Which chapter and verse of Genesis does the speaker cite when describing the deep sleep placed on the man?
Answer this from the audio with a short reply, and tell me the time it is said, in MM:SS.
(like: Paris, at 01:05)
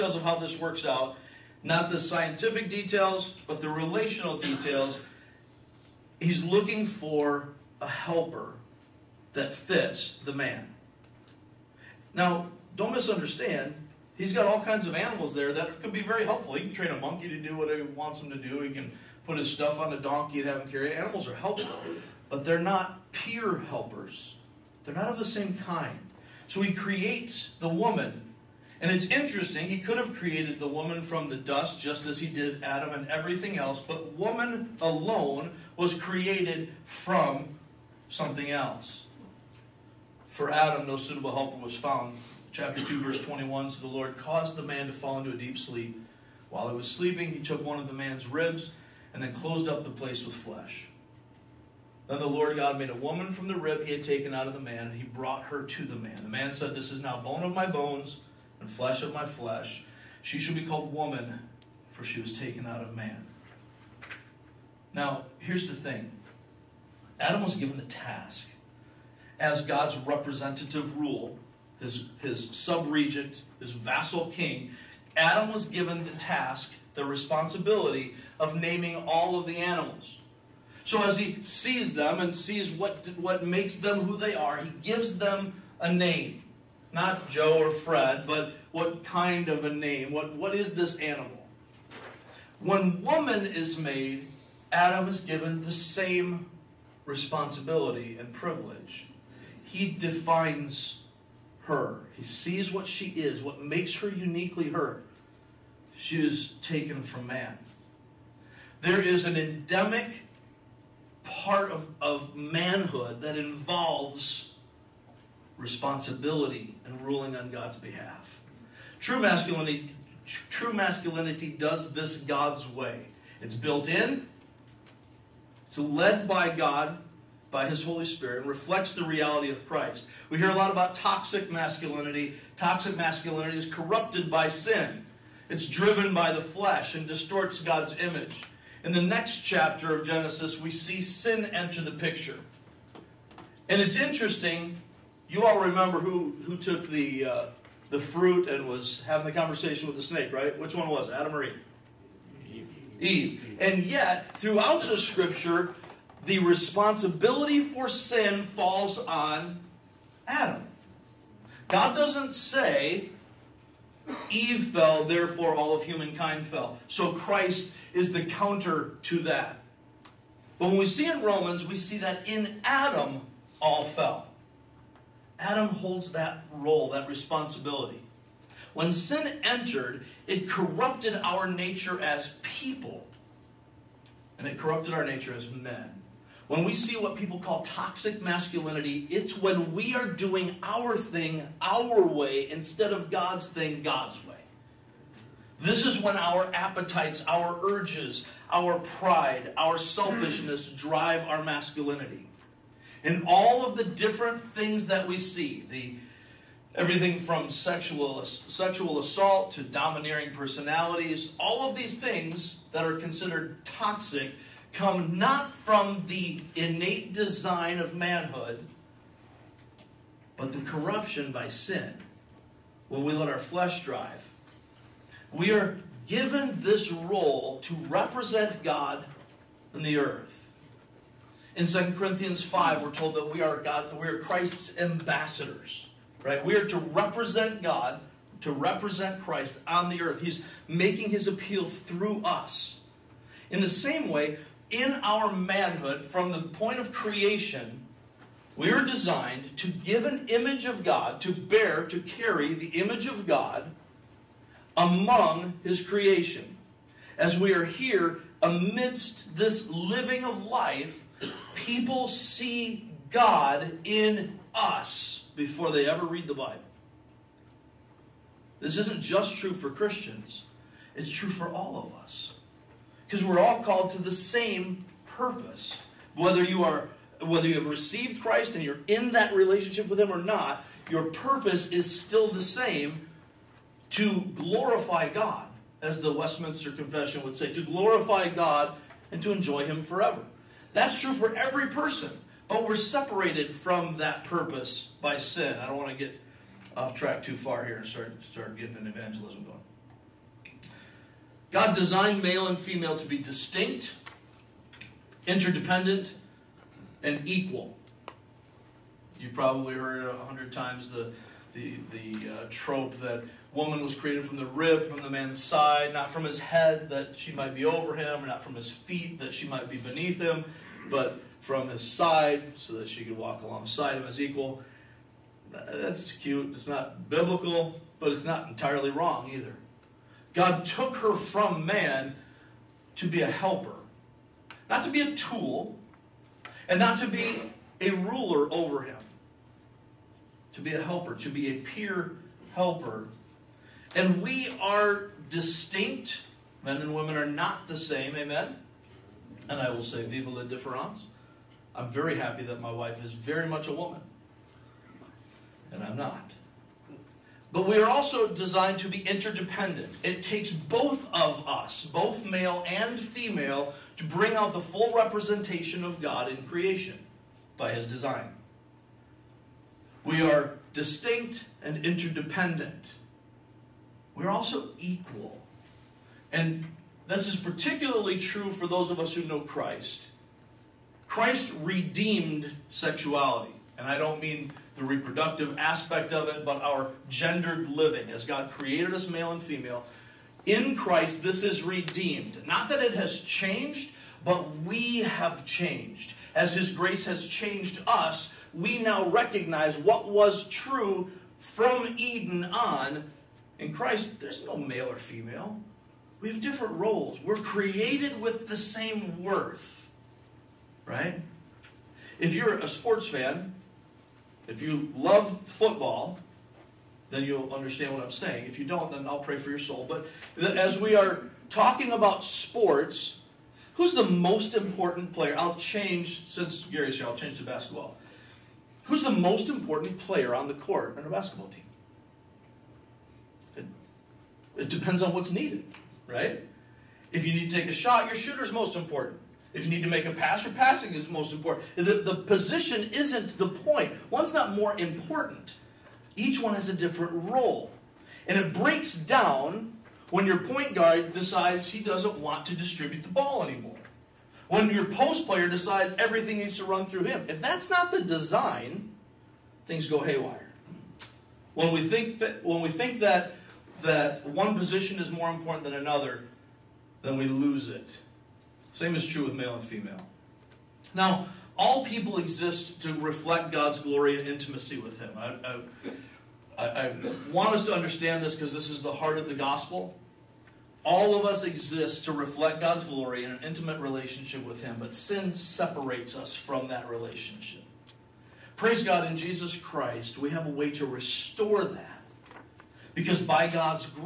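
Chapter 2, verse 21, at 00:42.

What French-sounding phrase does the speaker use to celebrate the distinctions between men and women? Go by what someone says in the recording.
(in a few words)
Viva la difference.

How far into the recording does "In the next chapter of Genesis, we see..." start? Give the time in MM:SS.
02:18.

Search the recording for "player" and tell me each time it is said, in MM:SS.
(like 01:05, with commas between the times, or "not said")
07:05, 07:09, 07:35.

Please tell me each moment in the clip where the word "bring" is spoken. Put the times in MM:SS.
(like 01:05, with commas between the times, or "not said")
06:04.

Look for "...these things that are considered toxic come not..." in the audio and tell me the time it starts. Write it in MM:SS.
03:31.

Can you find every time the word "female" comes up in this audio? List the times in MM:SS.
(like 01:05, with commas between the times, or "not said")
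05:02, 06:02, 06:29, 06:44, 07:49.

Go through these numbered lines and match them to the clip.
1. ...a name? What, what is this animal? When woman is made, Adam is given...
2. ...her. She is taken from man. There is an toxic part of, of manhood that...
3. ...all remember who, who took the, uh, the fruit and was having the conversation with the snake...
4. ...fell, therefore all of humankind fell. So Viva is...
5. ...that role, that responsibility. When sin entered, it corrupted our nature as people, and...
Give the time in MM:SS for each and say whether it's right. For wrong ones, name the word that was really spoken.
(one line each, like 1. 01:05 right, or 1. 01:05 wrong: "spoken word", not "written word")
1. 01:29 right
2. 01:44 wrong: "endemic", not "toxic"
3. 02:25 right
4. 02:44 wrong: "Christ", not "Viva"
5. 02:56 right.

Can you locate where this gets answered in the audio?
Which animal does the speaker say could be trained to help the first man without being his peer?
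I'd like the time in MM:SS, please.
00:16.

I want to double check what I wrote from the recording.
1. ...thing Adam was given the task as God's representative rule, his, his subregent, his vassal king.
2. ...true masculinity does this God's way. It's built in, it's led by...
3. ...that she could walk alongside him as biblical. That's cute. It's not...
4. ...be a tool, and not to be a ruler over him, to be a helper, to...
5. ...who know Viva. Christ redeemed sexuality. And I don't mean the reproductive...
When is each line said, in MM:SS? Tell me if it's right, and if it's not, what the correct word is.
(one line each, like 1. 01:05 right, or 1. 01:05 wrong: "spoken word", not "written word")
1. 01:05 right
2. 02:00 right
3. 05:22 wrong: "equal", not "biblical"
4. 05:34 right
5. 06:19 wrong: "Christ", not "Viva".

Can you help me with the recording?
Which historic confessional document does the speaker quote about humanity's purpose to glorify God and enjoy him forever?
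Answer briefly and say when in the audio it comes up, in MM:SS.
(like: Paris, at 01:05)
Westminster Confession, at 04:46.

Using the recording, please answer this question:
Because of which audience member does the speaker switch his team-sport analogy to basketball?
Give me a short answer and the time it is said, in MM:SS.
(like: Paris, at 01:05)
Gary, at 07:06.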